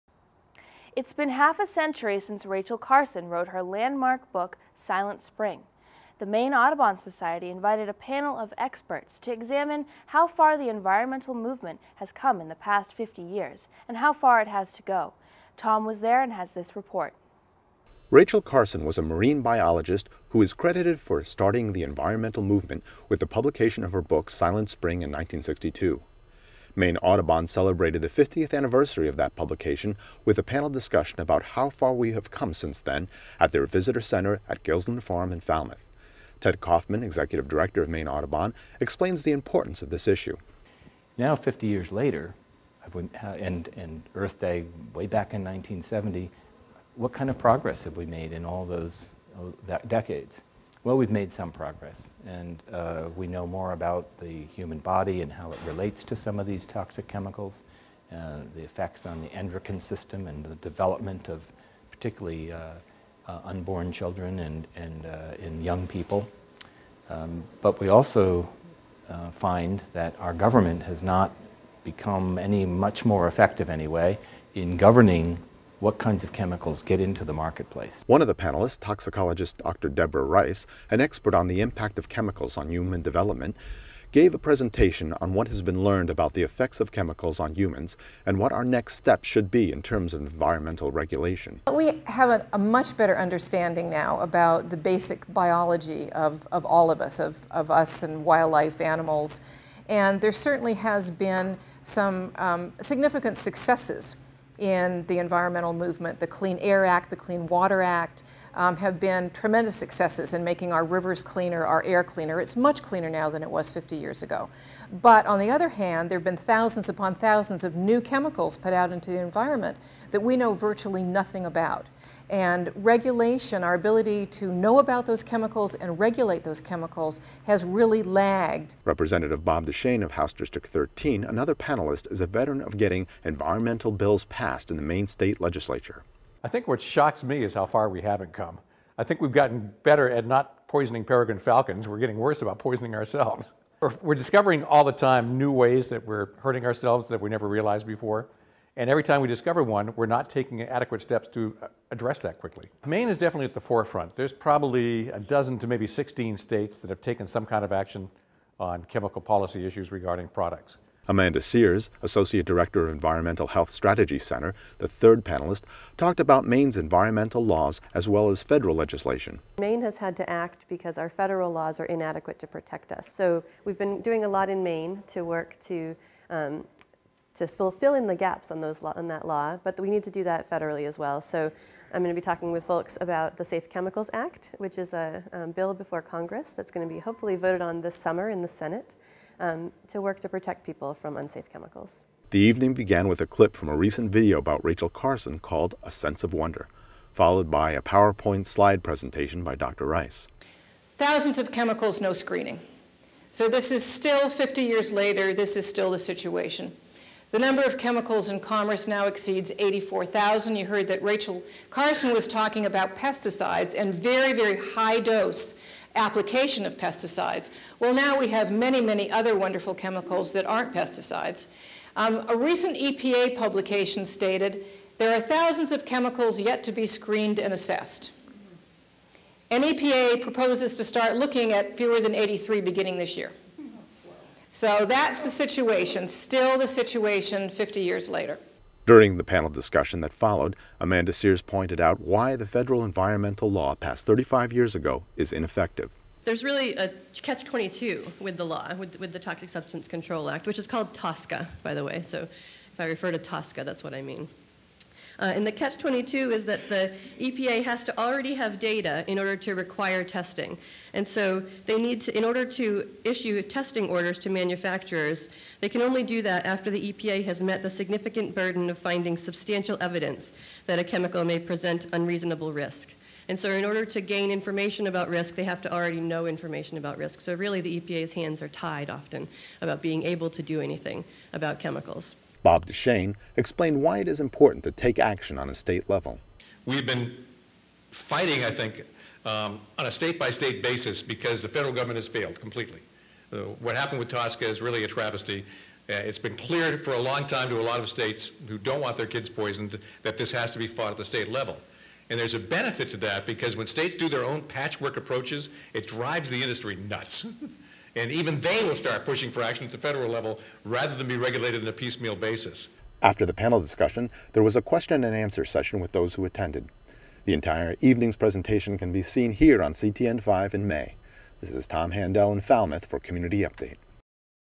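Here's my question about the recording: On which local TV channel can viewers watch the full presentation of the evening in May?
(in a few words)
CTN 5.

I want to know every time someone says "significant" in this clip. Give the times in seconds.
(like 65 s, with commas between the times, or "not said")
102 s, 267 s.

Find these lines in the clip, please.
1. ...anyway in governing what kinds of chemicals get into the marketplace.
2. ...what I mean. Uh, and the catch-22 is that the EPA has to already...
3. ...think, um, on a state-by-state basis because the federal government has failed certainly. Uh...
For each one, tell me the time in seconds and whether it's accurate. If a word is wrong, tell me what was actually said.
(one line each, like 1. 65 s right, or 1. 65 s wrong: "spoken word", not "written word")
1. 73 s right
2. 253 s right
3. 288 s wrong: "completely", not "certainly".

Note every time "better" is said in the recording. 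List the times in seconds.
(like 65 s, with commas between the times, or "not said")
92 s, 139 s.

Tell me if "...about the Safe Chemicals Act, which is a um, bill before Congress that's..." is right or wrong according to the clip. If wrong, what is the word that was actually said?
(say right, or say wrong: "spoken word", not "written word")
right.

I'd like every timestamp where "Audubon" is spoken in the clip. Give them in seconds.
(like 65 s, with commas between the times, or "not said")
6 s, 26 s, 38 s.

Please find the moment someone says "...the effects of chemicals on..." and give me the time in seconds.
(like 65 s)
86 s.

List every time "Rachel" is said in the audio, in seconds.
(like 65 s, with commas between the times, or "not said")
2 s, 18 s, 194 s, 211 s.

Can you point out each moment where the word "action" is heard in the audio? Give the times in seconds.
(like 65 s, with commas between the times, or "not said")
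157 s, 284 s, 309 s.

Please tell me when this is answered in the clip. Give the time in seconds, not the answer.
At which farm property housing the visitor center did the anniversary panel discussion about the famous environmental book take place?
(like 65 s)
34 s.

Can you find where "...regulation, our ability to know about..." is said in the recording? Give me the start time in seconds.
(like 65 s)
122 s.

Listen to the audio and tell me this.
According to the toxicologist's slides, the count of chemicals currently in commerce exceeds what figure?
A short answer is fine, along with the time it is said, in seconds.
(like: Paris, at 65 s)
84,000, at 209 s.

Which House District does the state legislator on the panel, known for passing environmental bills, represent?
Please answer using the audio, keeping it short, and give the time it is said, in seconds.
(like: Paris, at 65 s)
13, at 130 s.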